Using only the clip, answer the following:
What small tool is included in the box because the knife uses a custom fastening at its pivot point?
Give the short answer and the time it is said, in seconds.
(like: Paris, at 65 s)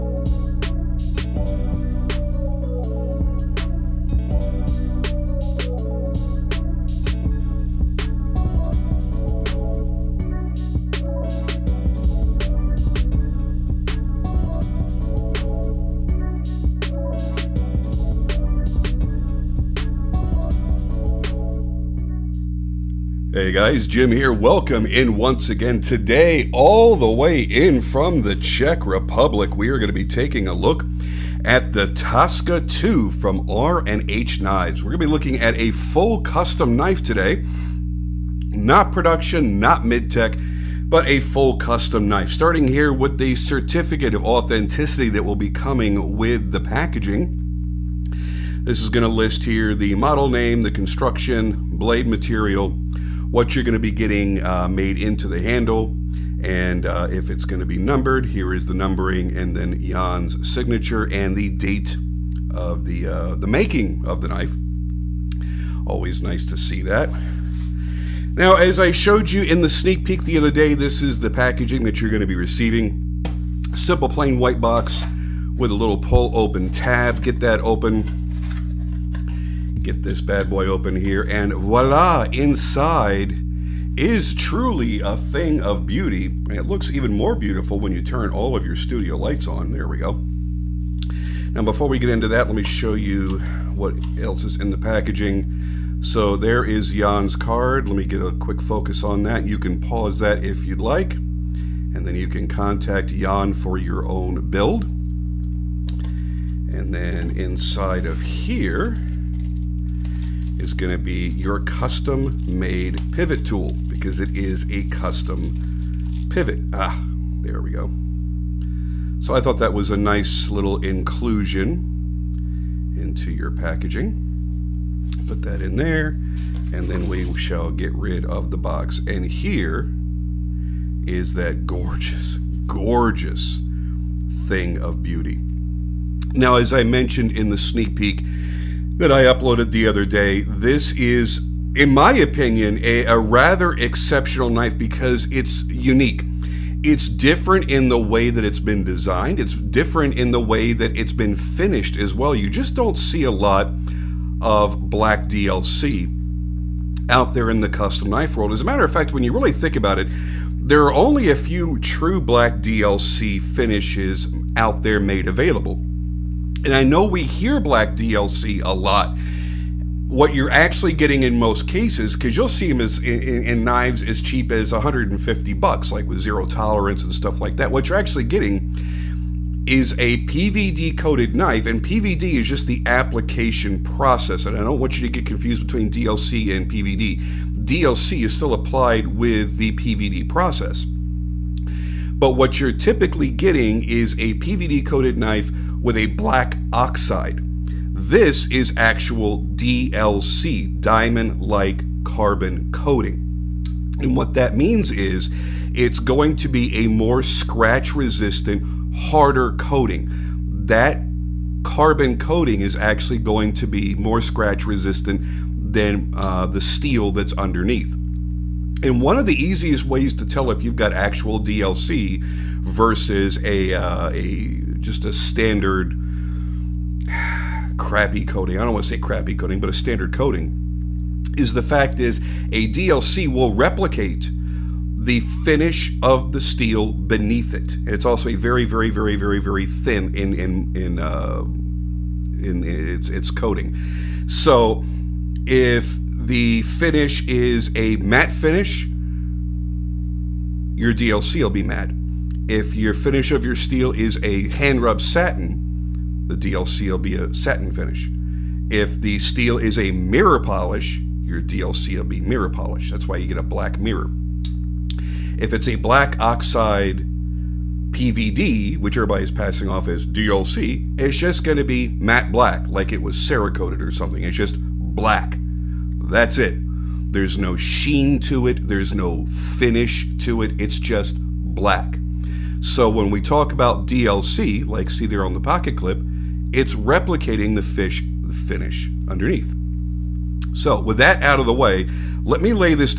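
pivot tool, at 113 s.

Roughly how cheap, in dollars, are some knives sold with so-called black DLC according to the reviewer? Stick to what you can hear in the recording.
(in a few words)
150.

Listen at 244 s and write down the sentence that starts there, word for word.
So if the finish is a matte finish, your DLC will be matte.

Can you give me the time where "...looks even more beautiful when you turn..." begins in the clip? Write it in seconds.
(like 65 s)
86 s.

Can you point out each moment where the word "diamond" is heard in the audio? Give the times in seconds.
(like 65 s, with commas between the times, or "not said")
200 s.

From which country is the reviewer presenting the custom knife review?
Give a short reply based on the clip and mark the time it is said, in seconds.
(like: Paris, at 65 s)
Czech Republic, at 28 s.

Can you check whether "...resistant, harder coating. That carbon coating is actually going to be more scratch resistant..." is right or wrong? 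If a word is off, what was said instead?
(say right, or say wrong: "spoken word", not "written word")
right.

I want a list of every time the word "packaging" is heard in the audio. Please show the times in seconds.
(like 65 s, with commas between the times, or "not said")
46 s, 71 s, 94 s, 123 s.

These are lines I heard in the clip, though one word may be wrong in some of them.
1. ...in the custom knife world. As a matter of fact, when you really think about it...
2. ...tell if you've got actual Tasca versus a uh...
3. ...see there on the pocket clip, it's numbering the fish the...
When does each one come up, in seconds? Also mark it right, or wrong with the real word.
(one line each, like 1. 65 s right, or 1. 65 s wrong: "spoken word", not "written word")
1. 157 s right
2. 220 s wrong: "DLC", not "Tasca"
3. 284 s wrong: "replicating", not "numbering".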